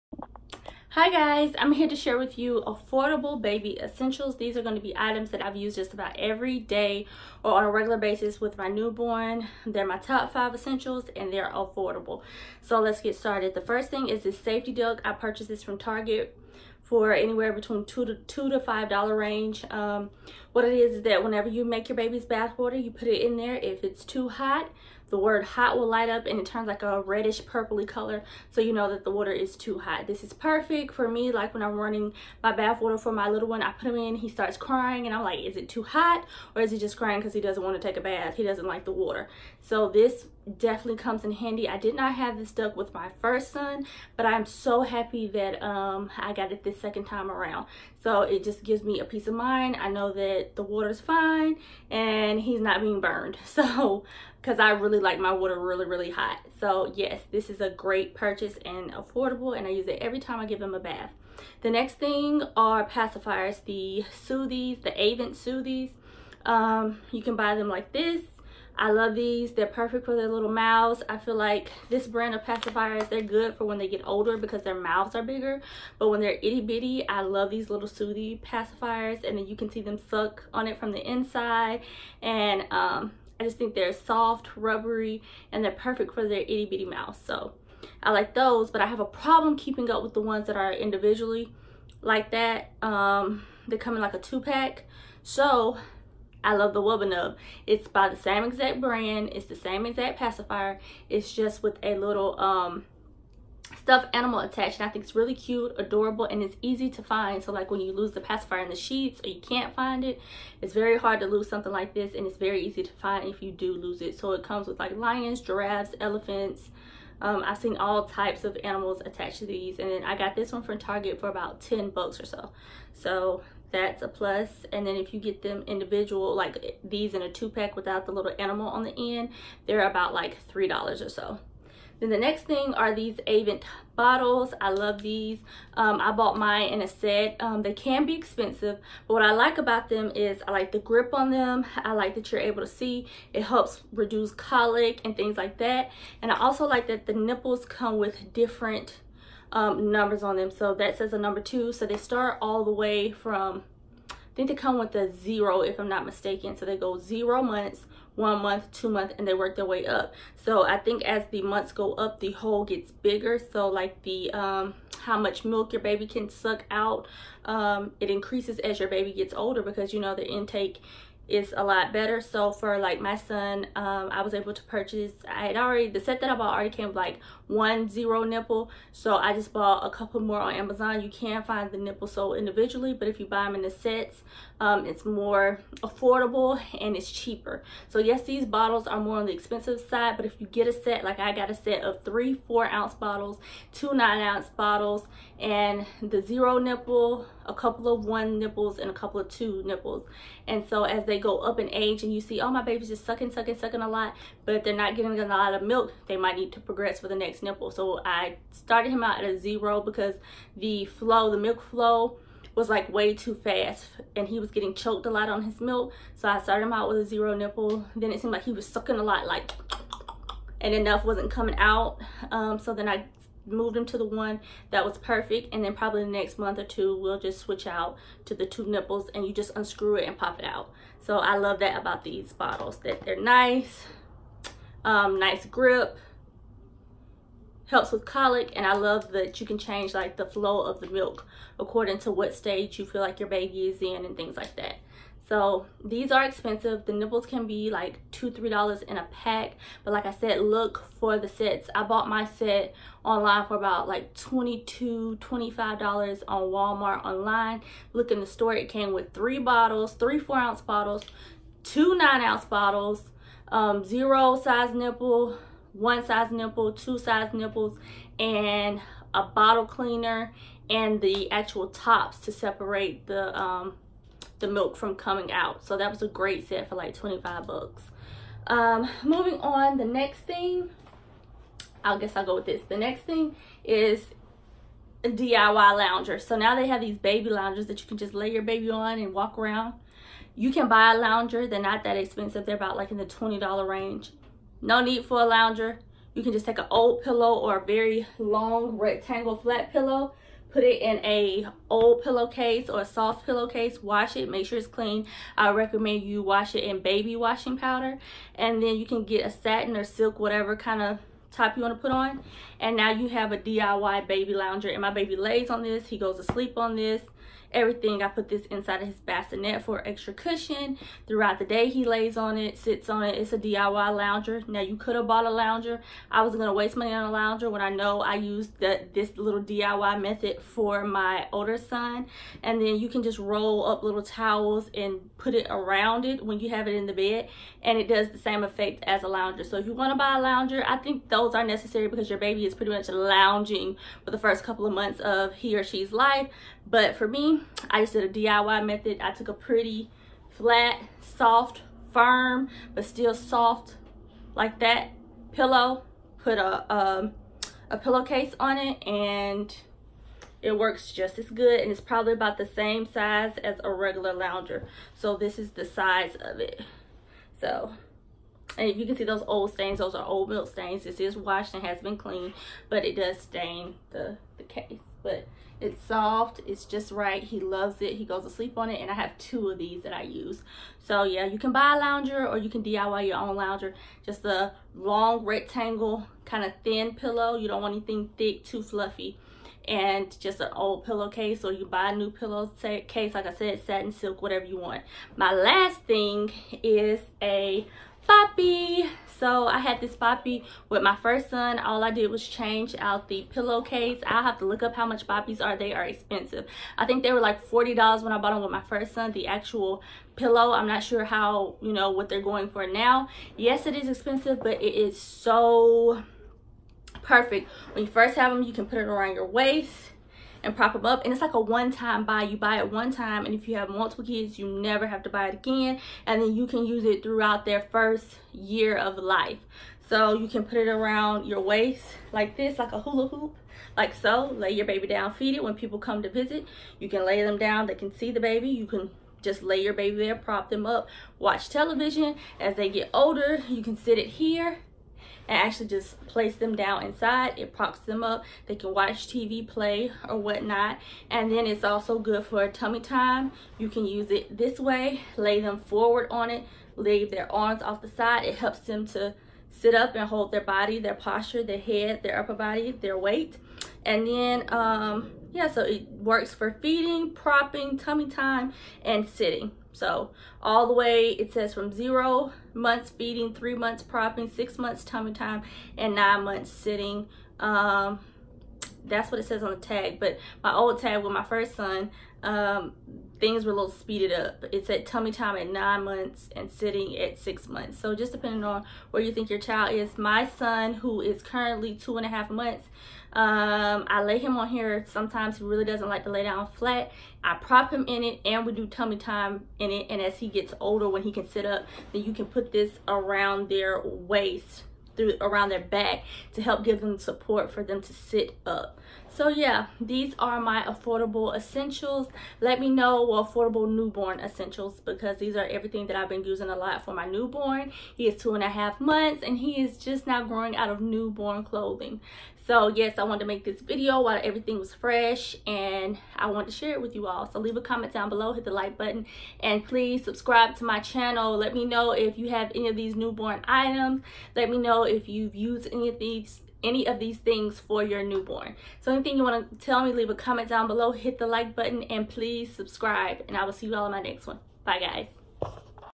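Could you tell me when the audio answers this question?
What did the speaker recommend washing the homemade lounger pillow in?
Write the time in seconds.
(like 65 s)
306 s.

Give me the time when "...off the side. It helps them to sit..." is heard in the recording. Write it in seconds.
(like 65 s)
457 s.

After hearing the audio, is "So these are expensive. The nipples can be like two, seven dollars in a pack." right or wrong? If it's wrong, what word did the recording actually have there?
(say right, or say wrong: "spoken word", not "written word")
wrong: "three", not "seven".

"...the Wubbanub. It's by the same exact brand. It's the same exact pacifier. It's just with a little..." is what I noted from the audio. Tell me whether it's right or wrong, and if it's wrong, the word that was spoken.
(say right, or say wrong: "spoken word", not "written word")
right.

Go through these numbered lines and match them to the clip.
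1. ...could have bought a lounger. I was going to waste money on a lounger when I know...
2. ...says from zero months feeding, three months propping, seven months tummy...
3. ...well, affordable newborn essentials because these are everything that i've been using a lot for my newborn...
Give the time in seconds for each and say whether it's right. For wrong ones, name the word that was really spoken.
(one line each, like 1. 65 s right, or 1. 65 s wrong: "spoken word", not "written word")
1. 324 s right
2. 471 s wrong: "six", not "seven"
3. 513 s right.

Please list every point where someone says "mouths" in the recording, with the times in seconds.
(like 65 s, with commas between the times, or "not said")
70 s, 74 s, 86 s.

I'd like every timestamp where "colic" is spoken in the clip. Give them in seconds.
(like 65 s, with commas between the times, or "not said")
144 s, 238 s.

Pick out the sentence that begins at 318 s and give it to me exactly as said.
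I put this inside of his bassinet for extra cushion.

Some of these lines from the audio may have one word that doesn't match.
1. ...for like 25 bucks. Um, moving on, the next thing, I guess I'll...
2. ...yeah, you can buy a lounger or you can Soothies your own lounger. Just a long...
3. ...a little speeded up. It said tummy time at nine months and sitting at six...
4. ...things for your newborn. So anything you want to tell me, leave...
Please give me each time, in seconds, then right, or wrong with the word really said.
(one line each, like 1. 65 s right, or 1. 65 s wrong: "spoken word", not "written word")
1. 276 s right
2. 381 s wrong: "DIY", not "Soothies"
3. 483 s right
4. 537 s right.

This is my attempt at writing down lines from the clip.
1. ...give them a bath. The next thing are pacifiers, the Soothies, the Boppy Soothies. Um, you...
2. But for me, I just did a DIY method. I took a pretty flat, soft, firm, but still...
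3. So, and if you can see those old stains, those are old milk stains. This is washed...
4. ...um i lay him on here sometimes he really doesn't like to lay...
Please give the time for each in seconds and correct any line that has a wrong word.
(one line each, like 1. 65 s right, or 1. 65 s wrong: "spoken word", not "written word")
1. 60 s wrong: "Avent", not "Boppy"
2. 346 s right
3. 367 s right
4. 493 s right.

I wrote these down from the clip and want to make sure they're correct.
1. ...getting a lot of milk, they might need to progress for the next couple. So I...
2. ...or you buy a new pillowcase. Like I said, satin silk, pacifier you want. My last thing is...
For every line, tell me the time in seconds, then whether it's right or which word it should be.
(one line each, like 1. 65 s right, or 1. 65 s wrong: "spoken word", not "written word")
1. 204 s wrong: "nipple", not "couple"
2. 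391 s wrong: "whatever", not "pacifier".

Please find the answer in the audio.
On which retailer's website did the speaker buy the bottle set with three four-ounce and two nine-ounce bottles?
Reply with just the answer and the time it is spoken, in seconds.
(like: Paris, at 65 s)
Walmart, at 256 s.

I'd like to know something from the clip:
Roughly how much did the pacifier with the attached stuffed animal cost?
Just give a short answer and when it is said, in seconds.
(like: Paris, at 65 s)
$10, at 121 s.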